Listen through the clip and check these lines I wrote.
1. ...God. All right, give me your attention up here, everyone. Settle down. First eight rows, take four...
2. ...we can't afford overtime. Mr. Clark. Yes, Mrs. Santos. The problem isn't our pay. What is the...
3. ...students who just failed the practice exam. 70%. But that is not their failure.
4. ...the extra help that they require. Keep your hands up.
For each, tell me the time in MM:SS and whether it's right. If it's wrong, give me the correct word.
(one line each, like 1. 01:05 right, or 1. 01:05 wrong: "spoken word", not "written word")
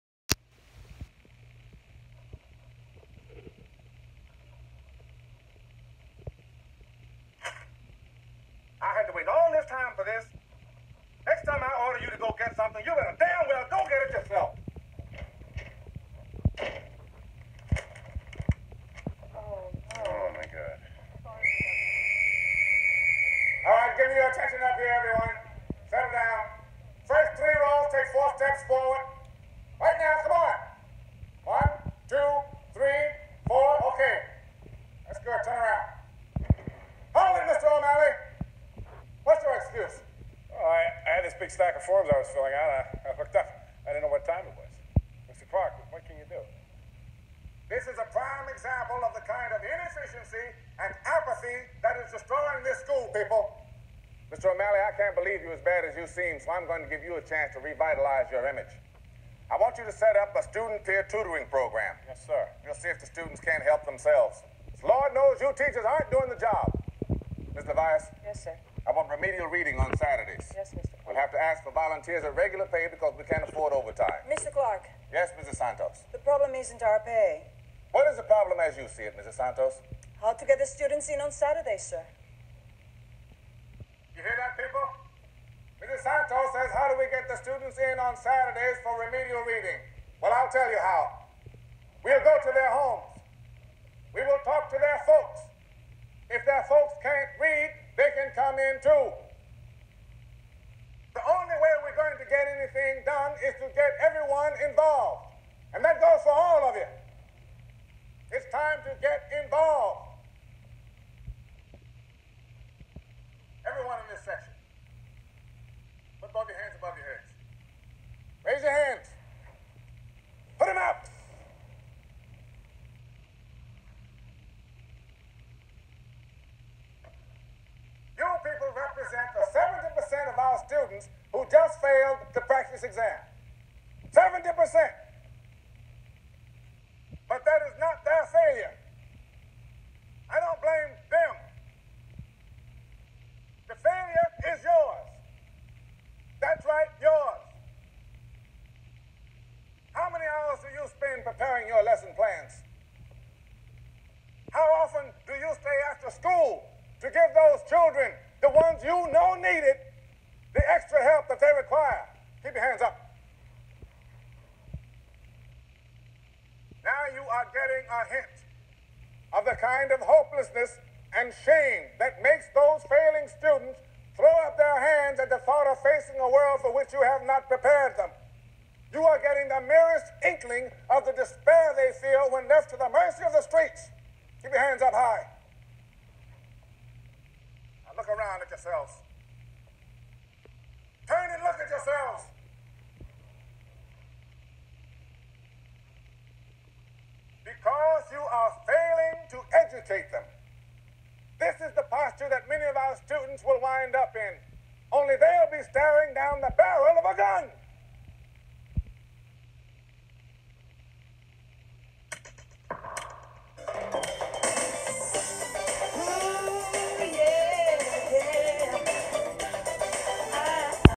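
1. 00:20 wrong: "three", not "eight"
2. 01:13 right
3. 02:10 right
4. 02:40 right.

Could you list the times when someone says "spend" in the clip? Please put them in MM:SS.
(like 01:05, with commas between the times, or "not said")
02:30.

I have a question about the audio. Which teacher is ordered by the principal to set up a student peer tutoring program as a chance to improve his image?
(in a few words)
Mr. O'Malley.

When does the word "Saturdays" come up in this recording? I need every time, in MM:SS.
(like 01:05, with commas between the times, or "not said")
01:09, 01:21, 01:28.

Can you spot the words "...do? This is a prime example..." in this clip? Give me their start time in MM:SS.
00:46.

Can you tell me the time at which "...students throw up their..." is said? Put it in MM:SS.
02:53.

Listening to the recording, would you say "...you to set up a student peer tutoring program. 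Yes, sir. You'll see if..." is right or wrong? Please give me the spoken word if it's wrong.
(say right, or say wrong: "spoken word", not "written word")
right.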